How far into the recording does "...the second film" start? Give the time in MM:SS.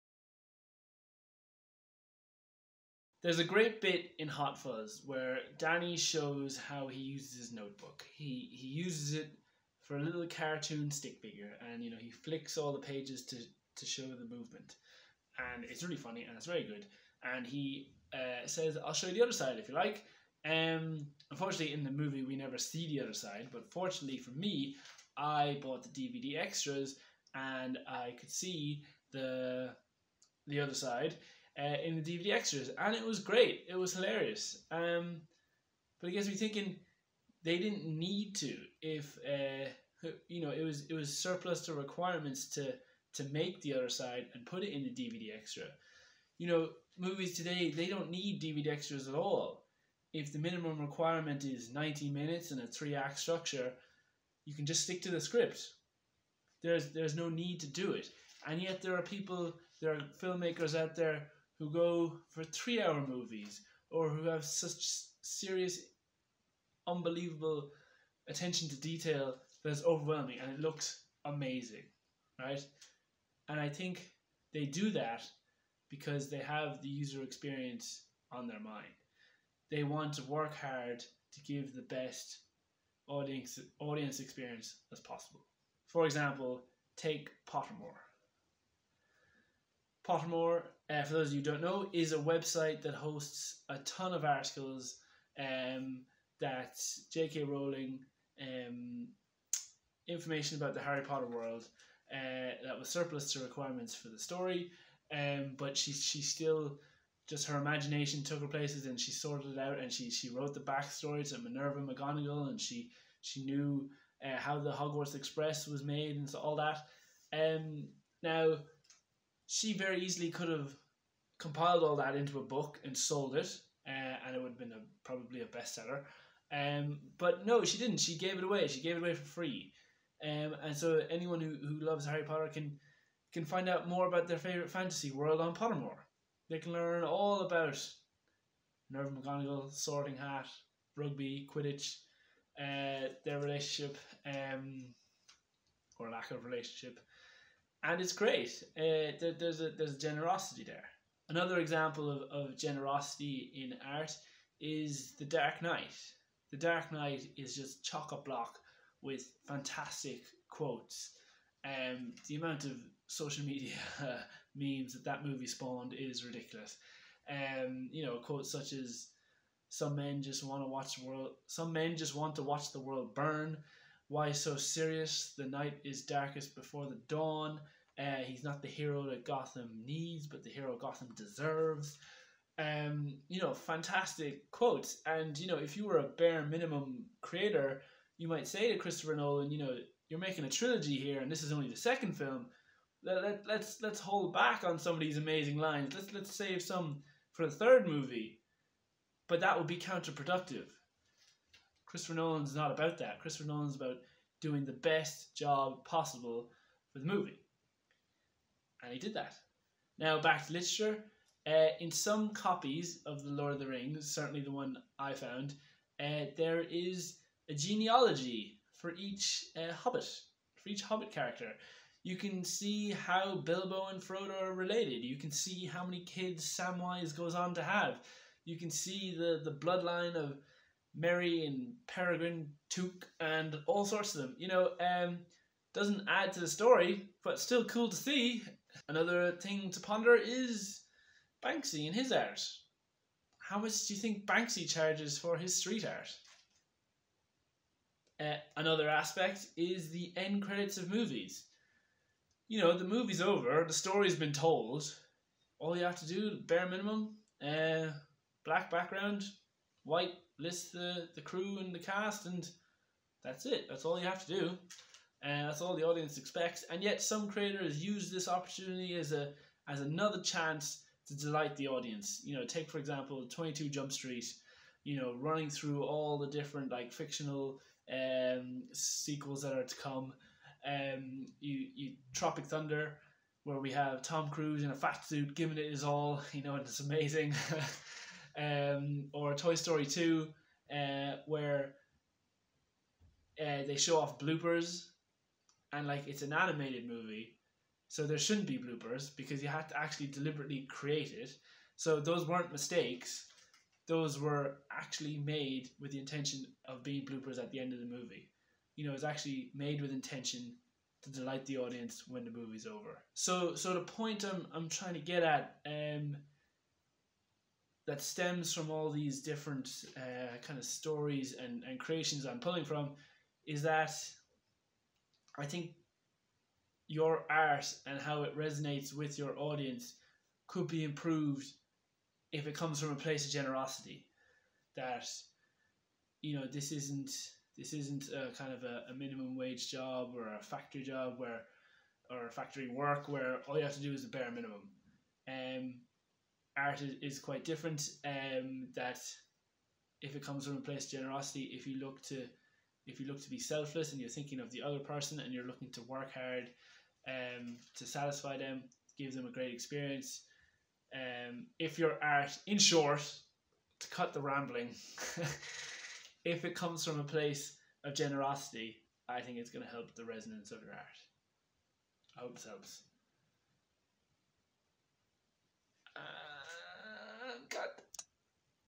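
03:11.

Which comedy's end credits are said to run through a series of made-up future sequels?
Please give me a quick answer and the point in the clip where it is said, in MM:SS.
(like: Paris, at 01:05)
22 Jump Street, at 04:33.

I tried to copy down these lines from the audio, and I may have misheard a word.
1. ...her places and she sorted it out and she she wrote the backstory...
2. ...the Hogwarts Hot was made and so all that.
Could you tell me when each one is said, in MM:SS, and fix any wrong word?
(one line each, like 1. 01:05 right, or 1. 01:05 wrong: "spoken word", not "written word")
1. 01:48 right
2. 01:54 wrong: "Express", not "Hot".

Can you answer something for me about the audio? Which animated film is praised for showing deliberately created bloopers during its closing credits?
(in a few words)
Toy Story 2.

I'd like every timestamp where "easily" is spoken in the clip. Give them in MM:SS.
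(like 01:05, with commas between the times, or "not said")
02:00.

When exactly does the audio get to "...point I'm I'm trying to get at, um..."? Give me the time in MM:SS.
05:13.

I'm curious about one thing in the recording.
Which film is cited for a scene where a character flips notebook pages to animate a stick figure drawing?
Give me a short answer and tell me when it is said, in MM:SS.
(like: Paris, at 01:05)
Hot Fuzz, at 00:04.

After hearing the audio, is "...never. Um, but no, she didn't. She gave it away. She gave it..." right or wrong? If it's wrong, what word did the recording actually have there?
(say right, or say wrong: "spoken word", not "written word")
wrong: "bestseller", not "never".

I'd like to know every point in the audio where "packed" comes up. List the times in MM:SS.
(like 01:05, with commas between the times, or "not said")
not said.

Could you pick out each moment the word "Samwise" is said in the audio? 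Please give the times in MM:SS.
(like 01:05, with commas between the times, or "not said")
03:46.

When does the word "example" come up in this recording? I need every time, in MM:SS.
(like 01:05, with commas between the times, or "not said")
01:26, 02:31, 04:32.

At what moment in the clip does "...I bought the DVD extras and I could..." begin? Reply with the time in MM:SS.
00:25.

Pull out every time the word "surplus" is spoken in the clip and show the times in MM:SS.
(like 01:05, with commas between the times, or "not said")
00:41, 01:42.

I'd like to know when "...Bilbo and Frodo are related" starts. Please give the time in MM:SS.
03:43.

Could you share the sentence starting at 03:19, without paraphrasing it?
But that would be counterproductive Christopher Nolan's not about that.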